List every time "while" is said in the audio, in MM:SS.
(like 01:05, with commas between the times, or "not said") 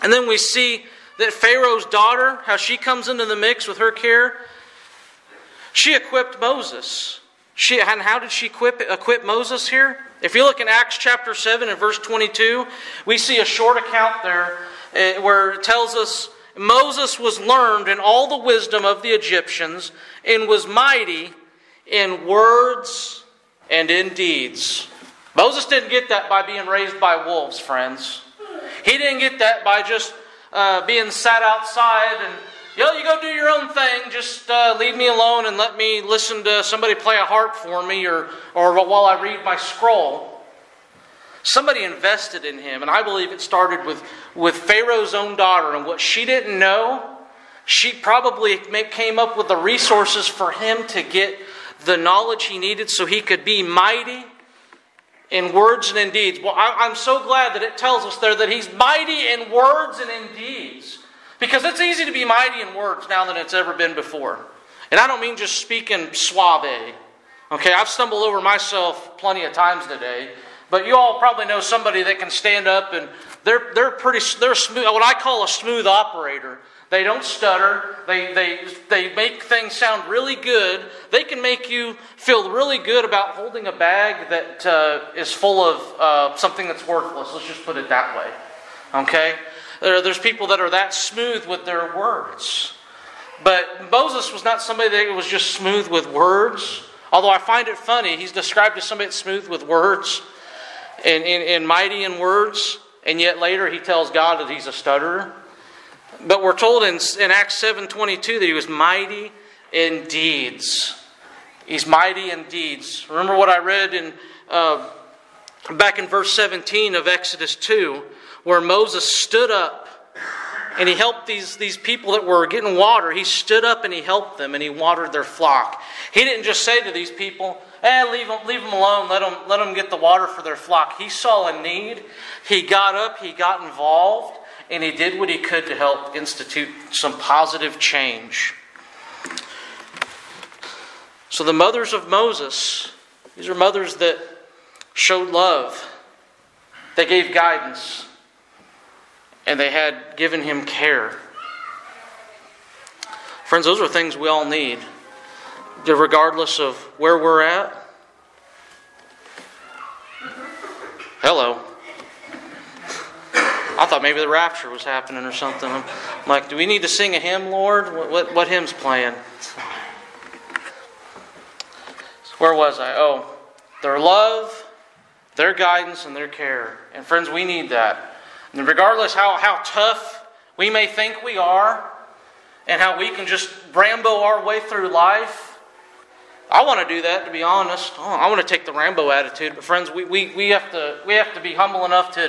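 00:38.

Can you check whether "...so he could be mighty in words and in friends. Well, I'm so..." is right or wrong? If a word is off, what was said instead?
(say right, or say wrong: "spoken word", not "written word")
wrong: "deeds", not "friends".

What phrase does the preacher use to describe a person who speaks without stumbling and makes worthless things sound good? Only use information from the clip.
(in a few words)
smooth operator.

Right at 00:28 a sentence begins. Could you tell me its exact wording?
He didn't get that by just uh, being sat outside and, yo, you go do your own thing.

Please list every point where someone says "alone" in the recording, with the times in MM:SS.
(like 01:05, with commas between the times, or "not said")
00:35, 02:08.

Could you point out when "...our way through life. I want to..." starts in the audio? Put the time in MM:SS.
03:04.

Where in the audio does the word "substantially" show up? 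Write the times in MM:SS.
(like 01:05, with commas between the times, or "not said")
not said.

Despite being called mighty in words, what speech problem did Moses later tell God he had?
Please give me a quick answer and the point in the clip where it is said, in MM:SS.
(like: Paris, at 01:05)
stutterer, at 01:44.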